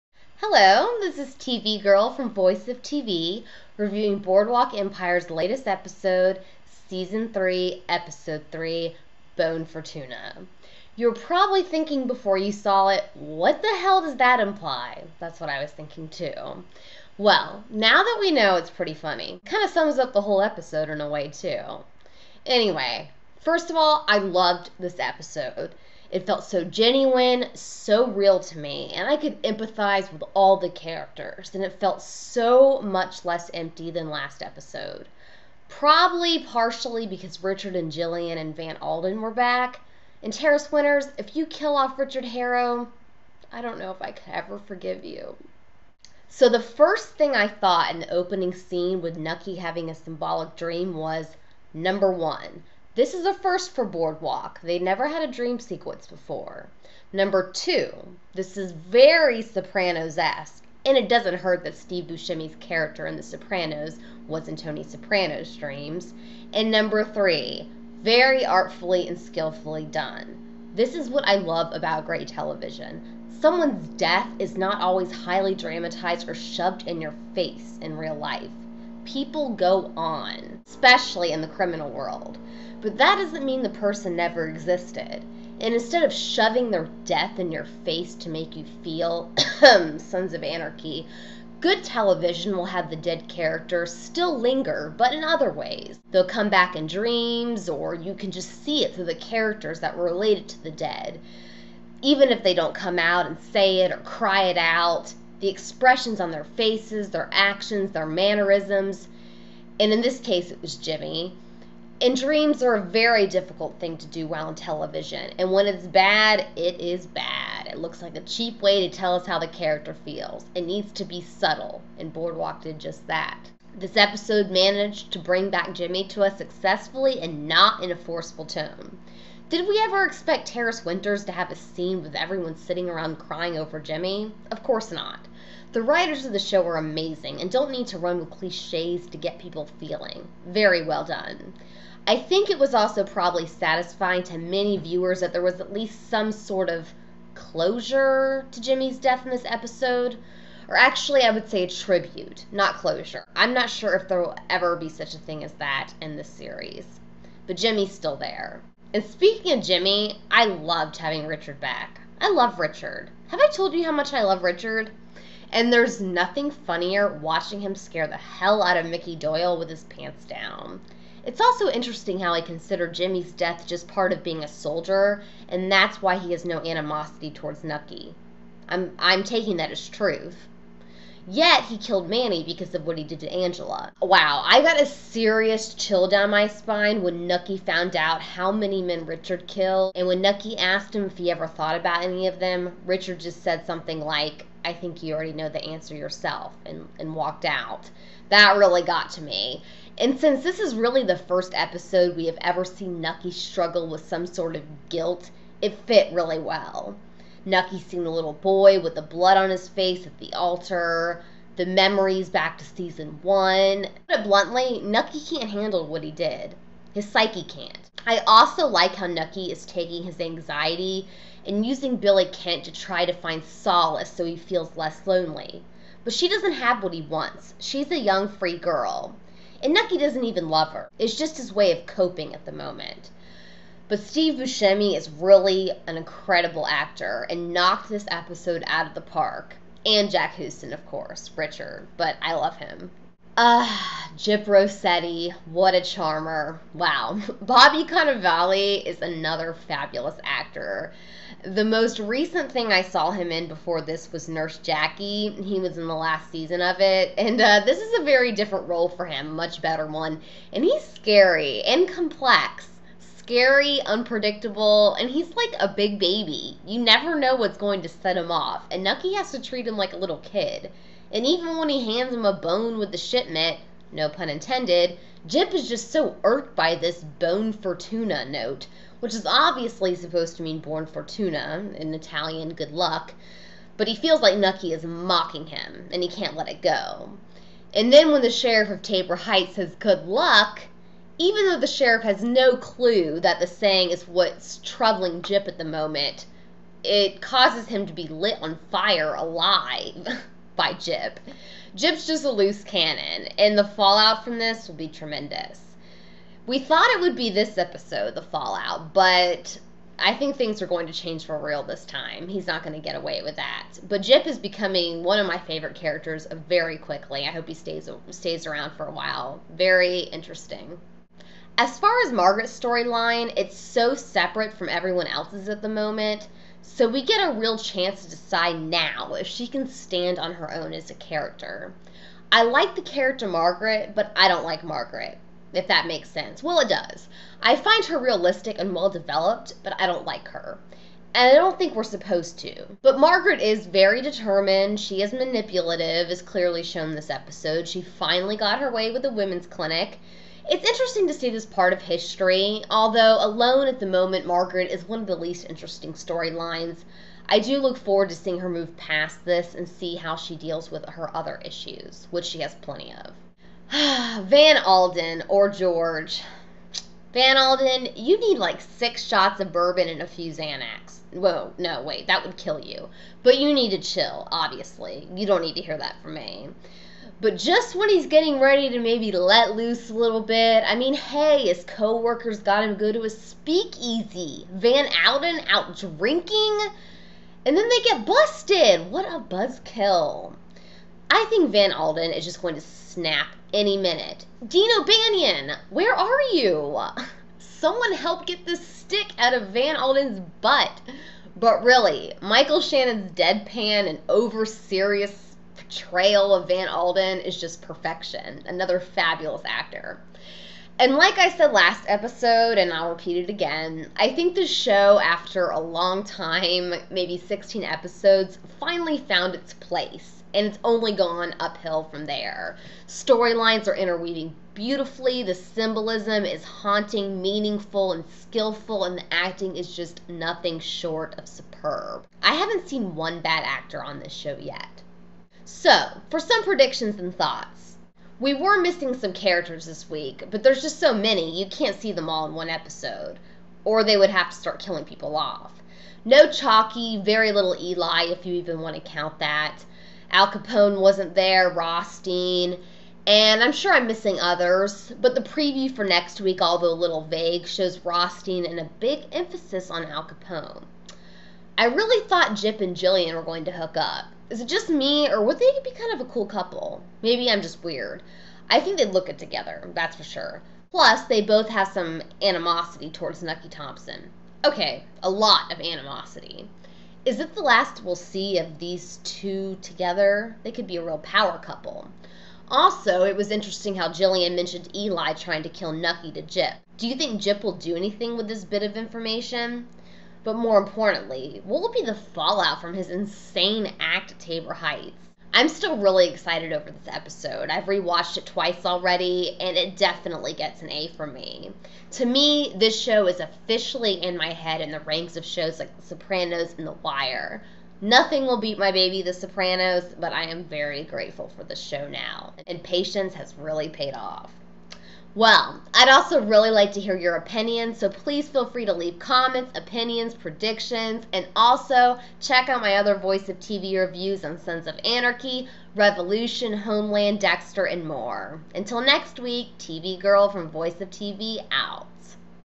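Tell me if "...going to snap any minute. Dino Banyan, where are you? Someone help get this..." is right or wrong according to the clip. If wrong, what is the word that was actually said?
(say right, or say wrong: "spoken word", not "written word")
right.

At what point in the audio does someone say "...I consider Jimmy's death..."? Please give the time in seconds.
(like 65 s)
172 s.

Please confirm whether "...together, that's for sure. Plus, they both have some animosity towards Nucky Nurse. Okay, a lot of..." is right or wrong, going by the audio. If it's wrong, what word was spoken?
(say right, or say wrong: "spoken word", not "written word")
wrong: "Thompson", not "Nurse".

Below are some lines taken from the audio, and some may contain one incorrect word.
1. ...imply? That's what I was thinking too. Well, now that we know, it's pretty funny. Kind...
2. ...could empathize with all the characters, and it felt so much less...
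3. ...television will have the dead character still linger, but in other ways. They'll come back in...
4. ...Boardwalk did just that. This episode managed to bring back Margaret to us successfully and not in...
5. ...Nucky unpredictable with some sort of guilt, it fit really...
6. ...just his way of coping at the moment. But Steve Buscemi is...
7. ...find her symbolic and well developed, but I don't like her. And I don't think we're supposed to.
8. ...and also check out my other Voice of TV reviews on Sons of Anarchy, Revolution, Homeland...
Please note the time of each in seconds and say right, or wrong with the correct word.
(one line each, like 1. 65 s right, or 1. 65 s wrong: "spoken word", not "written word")
1. 14 s right
2. 29 s right
3. 91 s right
4. 122 s wrong: "Jimmy", not "Margaret"
5. 203 s wrong: "struggle", not "unpredictable"
6. 231 s right
7. 337 s wrong: "realistic", not "symbolic"
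8. 521 s right.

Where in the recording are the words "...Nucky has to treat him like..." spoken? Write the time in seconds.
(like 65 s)
268 s.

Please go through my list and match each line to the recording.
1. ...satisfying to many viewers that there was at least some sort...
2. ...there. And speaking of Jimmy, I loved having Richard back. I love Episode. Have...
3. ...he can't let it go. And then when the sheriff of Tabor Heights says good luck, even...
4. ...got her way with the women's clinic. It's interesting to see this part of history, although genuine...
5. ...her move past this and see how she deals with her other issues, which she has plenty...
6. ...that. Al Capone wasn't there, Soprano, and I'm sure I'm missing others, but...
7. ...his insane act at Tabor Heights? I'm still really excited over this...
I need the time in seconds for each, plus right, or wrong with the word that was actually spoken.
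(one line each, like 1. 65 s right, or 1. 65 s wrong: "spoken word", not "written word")
1. 143 s right
2. 158 s wrong: "Richard", not "Episode"
3. 286 s right
4. 348 s wrong: "alone", not "genuine"
5. 358 s right
6. 449 s wrong: "Rothstein", not "Soprano"
7. 492 s right.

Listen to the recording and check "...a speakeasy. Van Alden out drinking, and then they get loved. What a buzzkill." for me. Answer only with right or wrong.
wrong.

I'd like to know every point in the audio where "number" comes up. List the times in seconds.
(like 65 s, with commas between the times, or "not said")
51 s, 57 s, 66 s.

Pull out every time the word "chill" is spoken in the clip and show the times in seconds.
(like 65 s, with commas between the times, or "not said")
185 s, 373 s.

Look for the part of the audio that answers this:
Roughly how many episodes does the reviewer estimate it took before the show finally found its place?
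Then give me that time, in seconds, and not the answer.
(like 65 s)
417 s.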